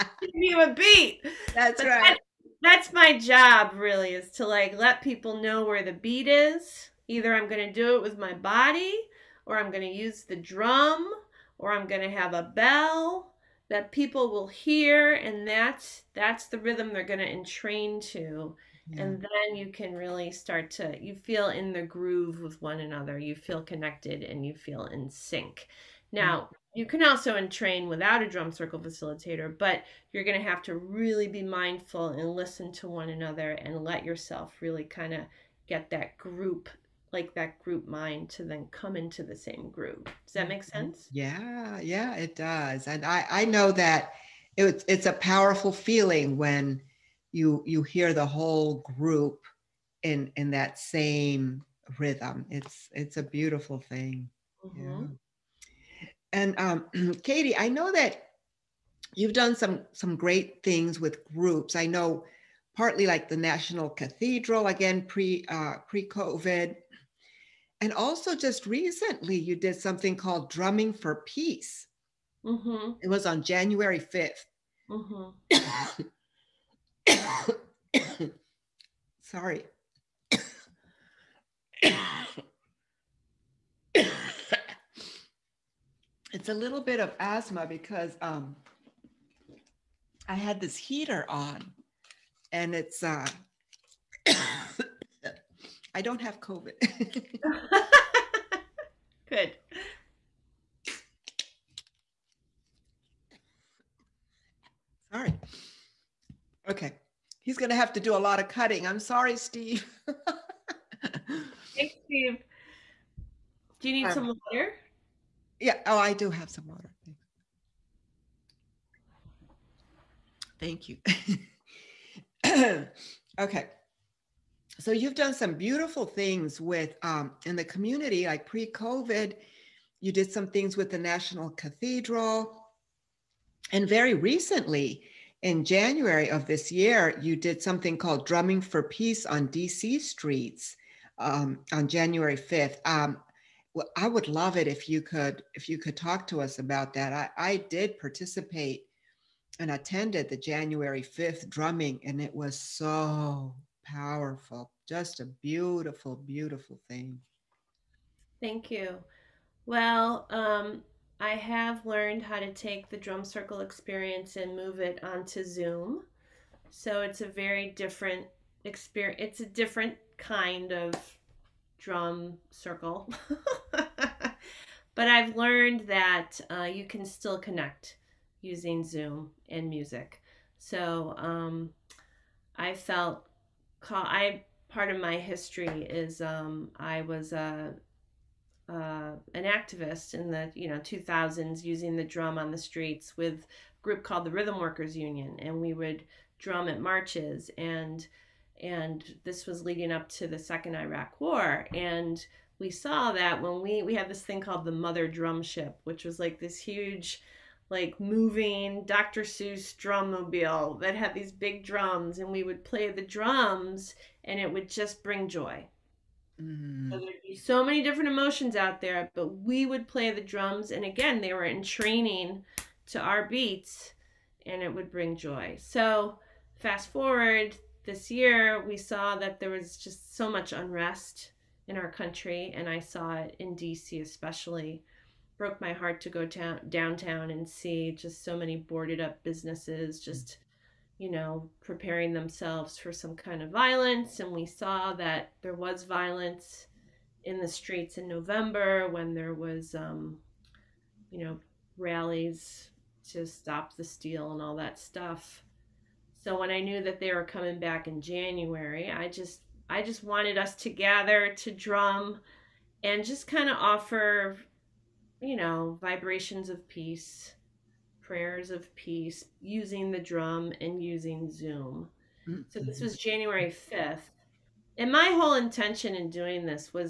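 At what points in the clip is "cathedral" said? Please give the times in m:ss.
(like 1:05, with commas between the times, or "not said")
1:03, 2:11.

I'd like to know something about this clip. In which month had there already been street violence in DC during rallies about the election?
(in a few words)
November.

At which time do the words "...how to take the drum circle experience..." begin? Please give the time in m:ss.
2:42.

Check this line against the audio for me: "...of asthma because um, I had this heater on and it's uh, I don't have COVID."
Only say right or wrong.
right.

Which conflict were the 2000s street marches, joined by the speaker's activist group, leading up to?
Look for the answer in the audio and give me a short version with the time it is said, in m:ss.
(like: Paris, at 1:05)
The second Iraq War, at 3:20.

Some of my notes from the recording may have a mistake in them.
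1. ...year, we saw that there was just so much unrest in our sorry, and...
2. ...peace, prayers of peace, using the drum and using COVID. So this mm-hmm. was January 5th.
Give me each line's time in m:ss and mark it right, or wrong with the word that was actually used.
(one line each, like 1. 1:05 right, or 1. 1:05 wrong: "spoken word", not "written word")
1. 3:48 wrong: "country", not "sorry"
2. 4:26 wrong: "Zoom", not "COVID".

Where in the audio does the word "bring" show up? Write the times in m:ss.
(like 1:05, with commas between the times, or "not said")
3:35, 3:44.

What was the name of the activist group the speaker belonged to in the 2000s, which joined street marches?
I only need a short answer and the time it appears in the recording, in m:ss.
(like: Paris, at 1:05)
Rhythm Workers Union, at 3:14.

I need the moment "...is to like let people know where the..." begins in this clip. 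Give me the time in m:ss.
0:04.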